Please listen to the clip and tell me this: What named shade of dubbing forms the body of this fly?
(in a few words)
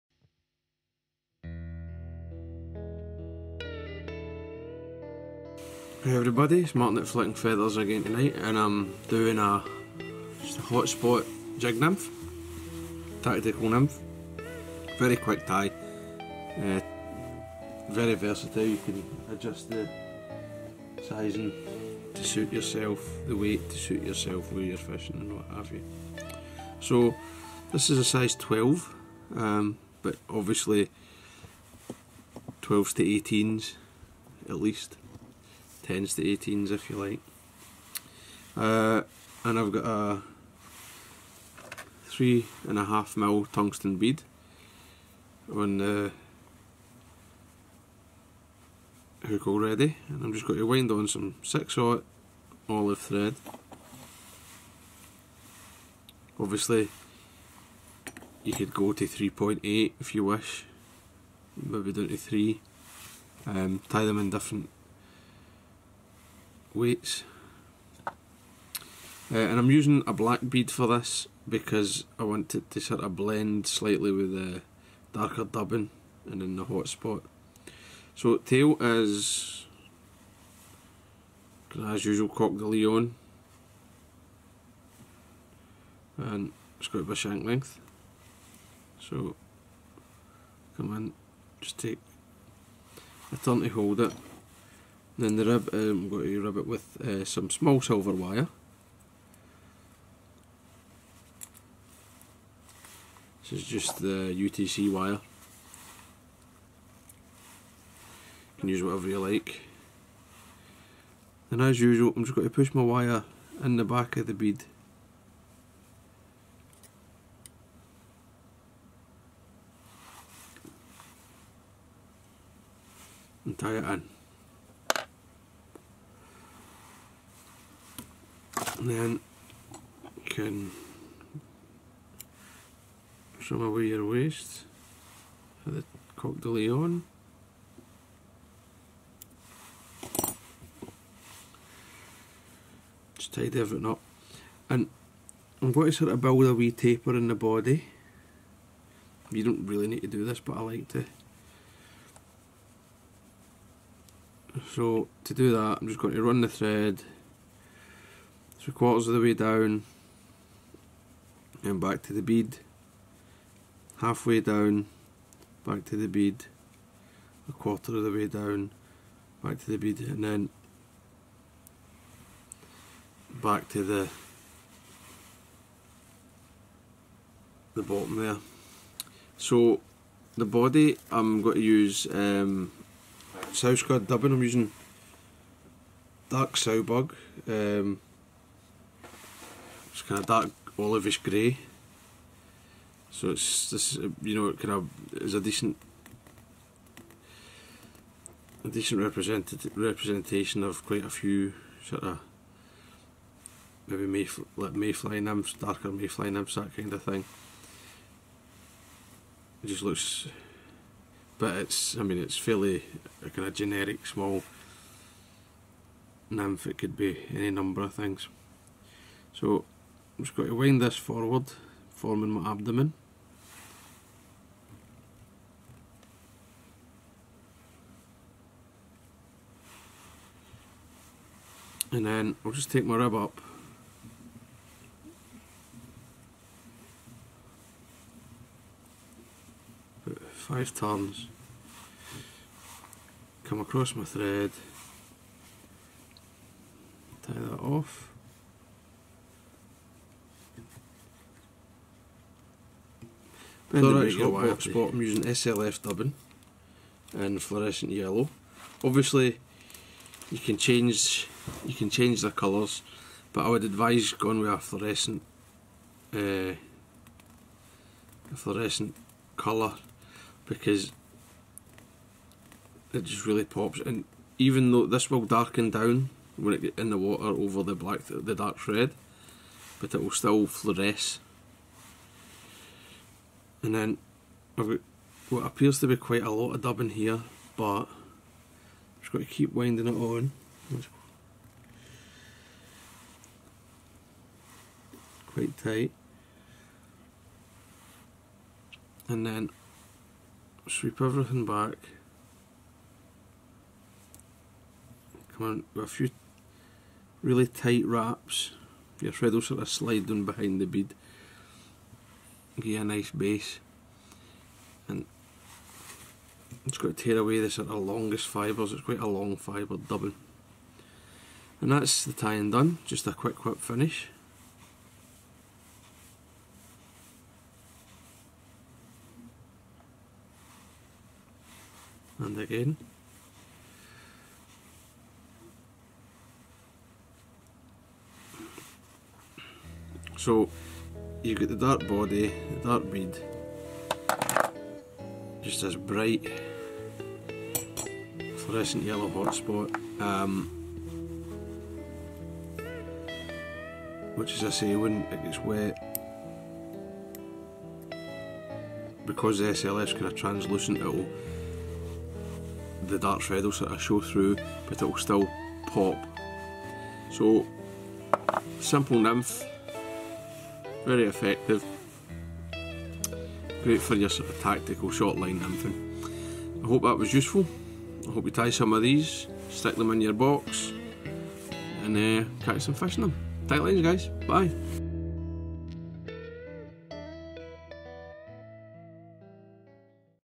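Dark sow bug.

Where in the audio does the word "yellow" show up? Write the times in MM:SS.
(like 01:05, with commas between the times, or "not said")
04:17, 05:48.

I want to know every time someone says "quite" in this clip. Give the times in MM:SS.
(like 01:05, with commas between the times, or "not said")
03:20, 04:45, 04:55, 05:18.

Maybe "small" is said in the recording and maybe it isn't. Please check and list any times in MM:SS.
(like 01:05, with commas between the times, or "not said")
01:37, 03:34.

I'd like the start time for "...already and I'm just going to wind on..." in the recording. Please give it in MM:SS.
00:49.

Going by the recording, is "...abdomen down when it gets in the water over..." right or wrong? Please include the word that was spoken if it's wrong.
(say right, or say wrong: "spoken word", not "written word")
wrong: "darken", not "abdomen".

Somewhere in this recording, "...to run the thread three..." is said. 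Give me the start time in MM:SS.
02:36.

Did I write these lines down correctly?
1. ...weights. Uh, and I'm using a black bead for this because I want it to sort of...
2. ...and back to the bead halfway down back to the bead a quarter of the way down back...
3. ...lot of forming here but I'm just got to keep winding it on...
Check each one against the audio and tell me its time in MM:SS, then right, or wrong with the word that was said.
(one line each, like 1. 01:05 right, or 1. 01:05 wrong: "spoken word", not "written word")
1. 01:06 right
2. 02:41 right
3. 04:46 wrong: "dubbing", not "forming".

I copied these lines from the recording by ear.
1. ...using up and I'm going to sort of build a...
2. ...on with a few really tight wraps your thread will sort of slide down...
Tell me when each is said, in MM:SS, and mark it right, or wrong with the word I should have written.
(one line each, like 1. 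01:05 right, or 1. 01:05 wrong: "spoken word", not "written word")
1. 02:23 wrong: "everything", not "using"
2. 05:05 right.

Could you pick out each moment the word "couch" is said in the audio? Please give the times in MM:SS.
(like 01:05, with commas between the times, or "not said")
not said.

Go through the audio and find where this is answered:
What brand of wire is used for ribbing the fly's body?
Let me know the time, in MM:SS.
01:44.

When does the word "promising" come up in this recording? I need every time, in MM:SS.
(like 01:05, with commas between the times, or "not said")
not said.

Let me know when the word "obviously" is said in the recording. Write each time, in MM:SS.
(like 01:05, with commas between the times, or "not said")
00:30, 00:56, 04:18.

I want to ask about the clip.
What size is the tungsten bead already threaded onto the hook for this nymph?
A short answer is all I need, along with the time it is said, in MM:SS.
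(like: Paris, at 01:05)
3.5 mm, at 00:42.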